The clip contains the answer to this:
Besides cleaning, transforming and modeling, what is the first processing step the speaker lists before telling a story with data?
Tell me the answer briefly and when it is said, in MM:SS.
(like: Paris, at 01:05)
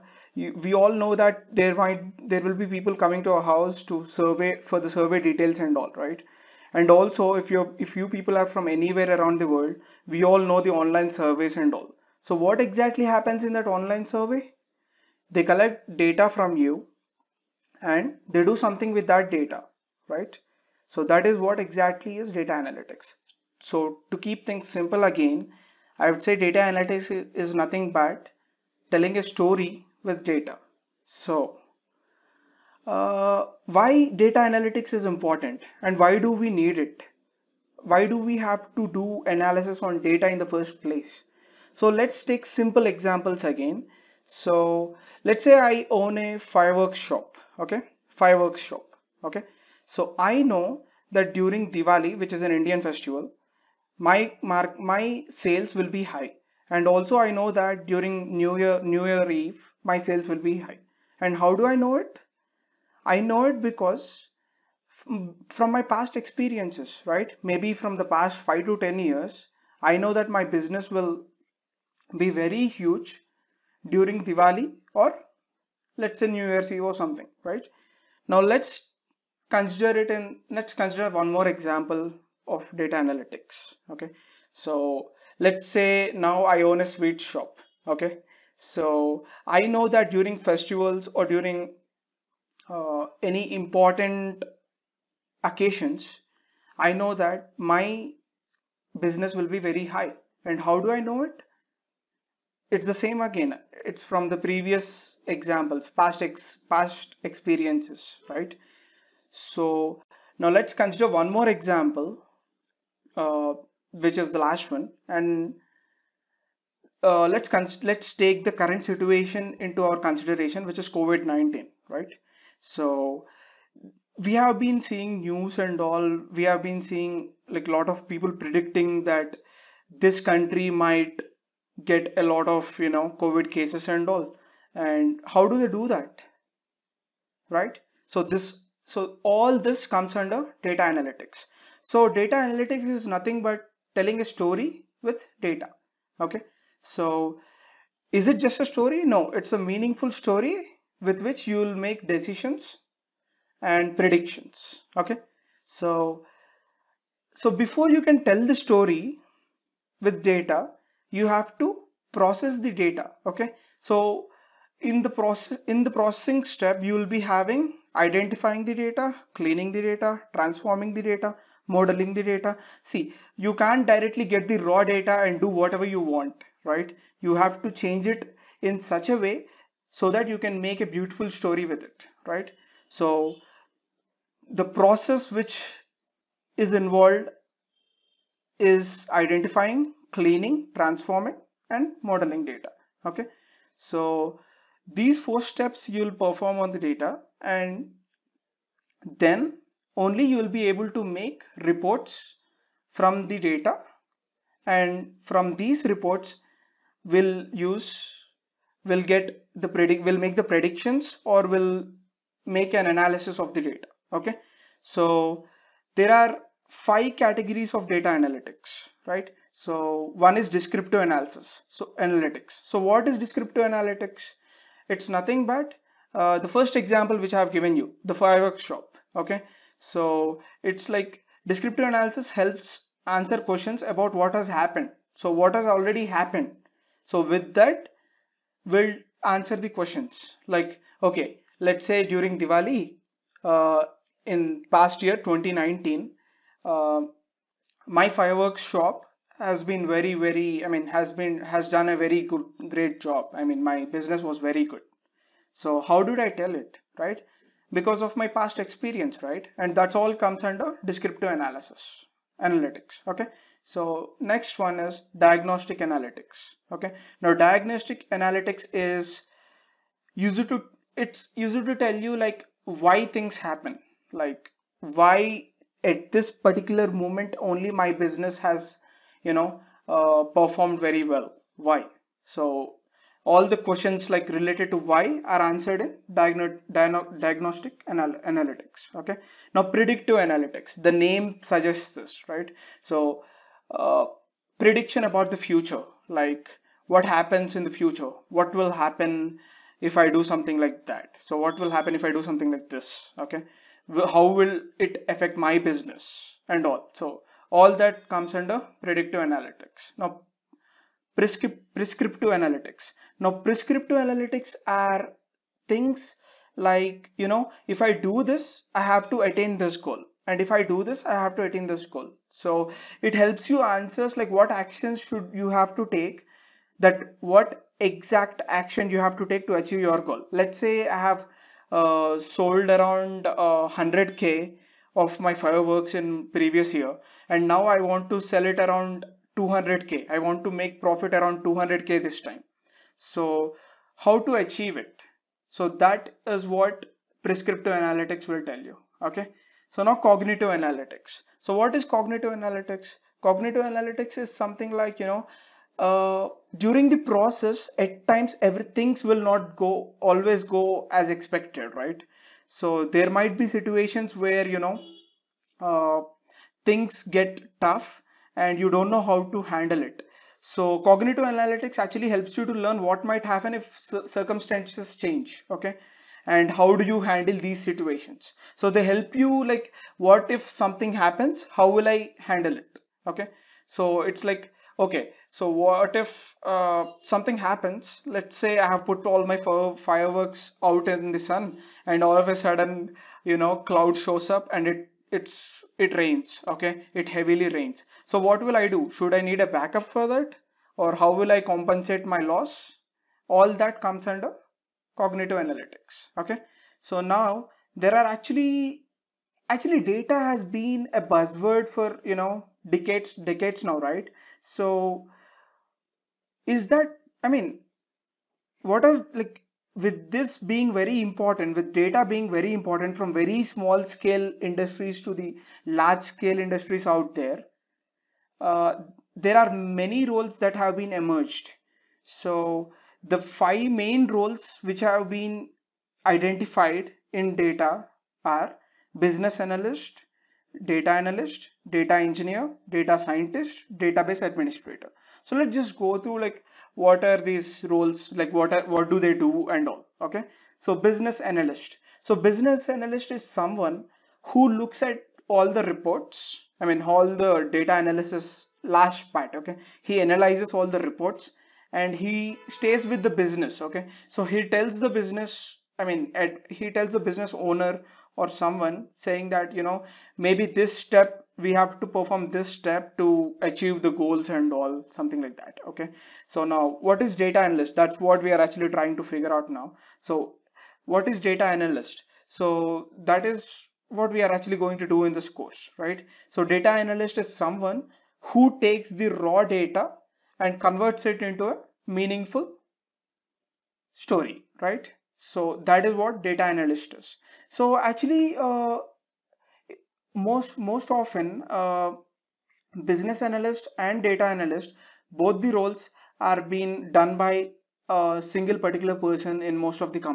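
Identifying the data, at 02:47.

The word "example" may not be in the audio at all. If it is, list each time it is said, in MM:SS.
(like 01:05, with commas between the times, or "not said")
00:42, 01:21, 01:45, 01:51, 03:46.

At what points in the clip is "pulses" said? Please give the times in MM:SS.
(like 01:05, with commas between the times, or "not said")
not said.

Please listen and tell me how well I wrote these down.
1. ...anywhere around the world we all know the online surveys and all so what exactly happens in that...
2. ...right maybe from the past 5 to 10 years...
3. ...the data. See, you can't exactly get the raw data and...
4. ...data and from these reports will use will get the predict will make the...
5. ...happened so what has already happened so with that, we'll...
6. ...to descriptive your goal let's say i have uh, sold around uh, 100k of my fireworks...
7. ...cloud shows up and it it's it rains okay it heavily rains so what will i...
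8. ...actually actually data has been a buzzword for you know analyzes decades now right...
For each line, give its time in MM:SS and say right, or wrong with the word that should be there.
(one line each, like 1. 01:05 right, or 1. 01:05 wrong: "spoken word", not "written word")
1. 00:08 right
2. 01:07 right
3. 02:52 wrong: "directly", not "exactly"
4. 03:23 right
5. 03:54 right
6. 05:29 wrong: "achieve", not "descriptive"
7. 06:33 right
8. 06:48 wrong: "decades", not "analyzes".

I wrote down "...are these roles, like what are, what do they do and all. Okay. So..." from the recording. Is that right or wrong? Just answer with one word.
right.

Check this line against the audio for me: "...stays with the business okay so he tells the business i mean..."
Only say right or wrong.
right.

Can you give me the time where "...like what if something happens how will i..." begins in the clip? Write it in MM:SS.
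06:19.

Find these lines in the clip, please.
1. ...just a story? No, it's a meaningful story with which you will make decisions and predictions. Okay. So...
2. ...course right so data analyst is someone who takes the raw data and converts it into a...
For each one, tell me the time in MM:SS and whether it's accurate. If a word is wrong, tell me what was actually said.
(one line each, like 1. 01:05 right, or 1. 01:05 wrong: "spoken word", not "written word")
1. 02:28 right
2. 08:05 right.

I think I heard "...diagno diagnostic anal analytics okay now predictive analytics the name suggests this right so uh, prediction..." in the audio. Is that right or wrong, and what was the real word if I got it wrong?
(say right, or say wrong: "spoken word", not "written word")
right.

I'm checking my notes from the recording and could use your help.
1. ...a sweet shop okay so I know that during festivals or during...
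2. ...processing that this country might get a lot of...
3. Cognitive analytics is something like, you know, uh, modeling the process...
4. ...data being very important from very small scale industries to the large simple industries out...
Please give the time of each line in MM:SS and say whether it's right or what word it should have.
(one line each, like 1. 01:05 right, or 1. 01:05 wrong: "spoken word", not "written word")
1. 01:26 right
2. 02:08 wrong: "predicting", not "processing"
3. 05:53 wrong: "during", not "modeling"
4. 07:01 wrong: "scale", not "simple".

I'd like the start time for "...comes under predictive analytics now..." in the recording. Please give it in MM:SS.
05:08.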